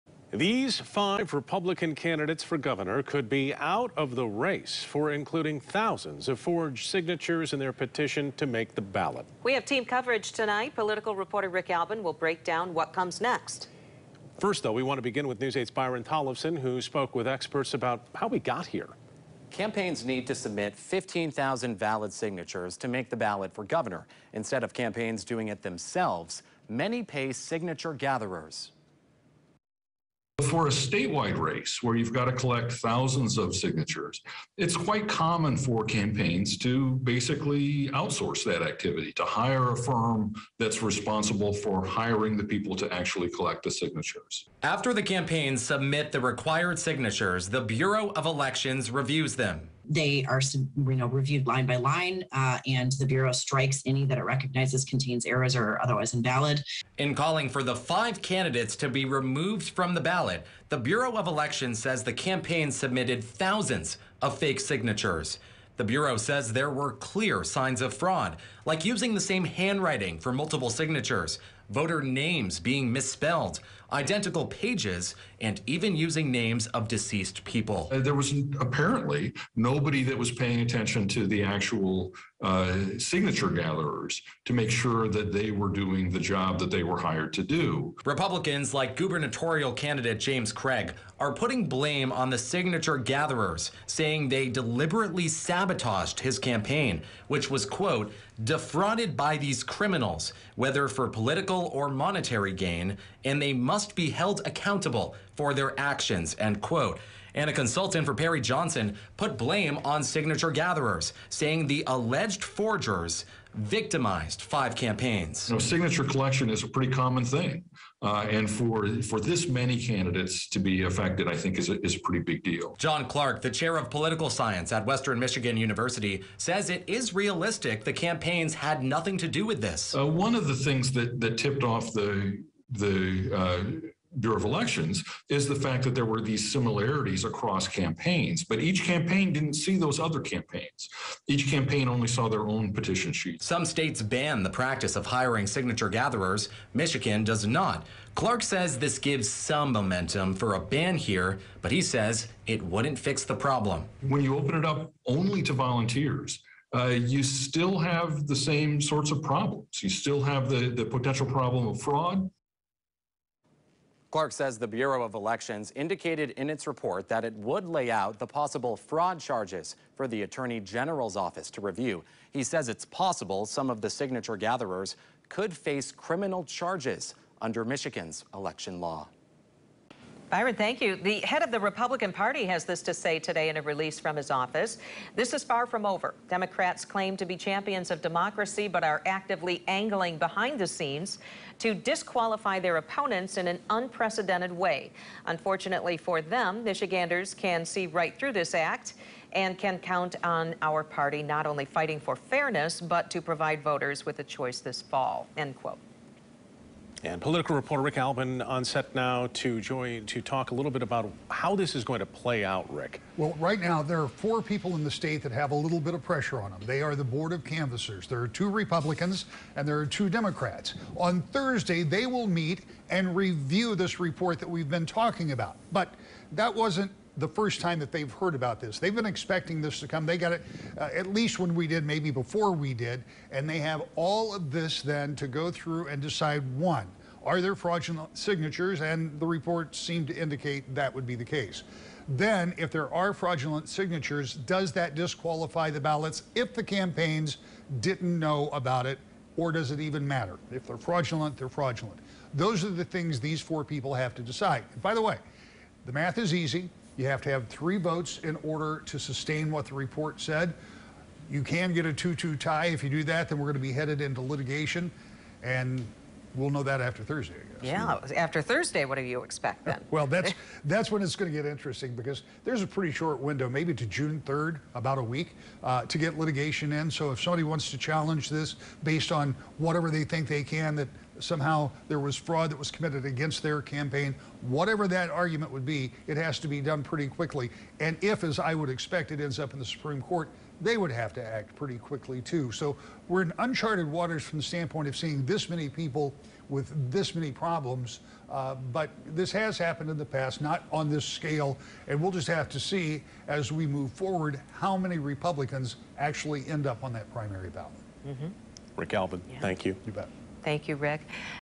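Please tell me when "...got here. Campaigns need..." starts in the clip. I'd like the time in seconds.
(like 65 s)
18 s.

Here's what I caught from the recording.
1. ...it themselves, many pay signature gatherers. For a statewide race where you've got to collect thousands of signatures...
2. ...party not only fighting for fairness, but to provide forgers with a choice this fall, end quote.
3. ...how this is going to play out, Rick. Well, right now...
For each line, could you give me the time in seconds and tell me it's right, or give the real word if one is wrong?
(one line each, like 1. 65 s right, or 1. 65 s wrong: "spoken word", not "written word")
1. 25 s right
2. 200 s wrong: "voters", not "forgers"
3. 211 s right.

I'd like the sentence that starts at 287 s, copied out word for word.
And if, as I would expect, it ends up in the Supreme Court, they would have to act pretty quickly too.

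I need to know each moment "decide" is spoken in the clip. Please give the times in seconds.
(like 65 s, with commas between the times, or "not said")
236 s, 254 s.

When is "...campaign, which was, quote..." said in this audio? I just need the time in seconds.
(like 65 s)
96 s.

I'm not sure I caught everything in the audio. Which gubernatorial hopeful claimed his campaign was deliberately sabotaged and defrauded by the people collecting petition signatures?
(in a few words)
James Craig.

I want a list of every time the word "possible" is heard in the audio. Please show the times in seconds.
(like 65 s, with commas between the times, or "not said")
168 s, 172 s.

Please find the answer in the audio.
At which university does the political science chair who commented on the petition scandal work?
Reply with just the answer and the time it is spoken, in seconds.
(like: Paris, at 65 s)
Western Michigan University, at 124 s.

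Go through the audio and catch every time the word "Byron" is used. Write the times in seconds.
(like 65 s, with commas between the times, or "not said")
15 s, 180 s.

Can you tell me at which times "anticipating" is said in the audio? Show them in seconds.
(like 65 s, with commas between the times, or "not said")
not said.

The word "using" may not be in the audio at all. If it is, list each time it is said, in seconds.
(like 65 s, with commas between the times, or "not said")
68 s, 75 s.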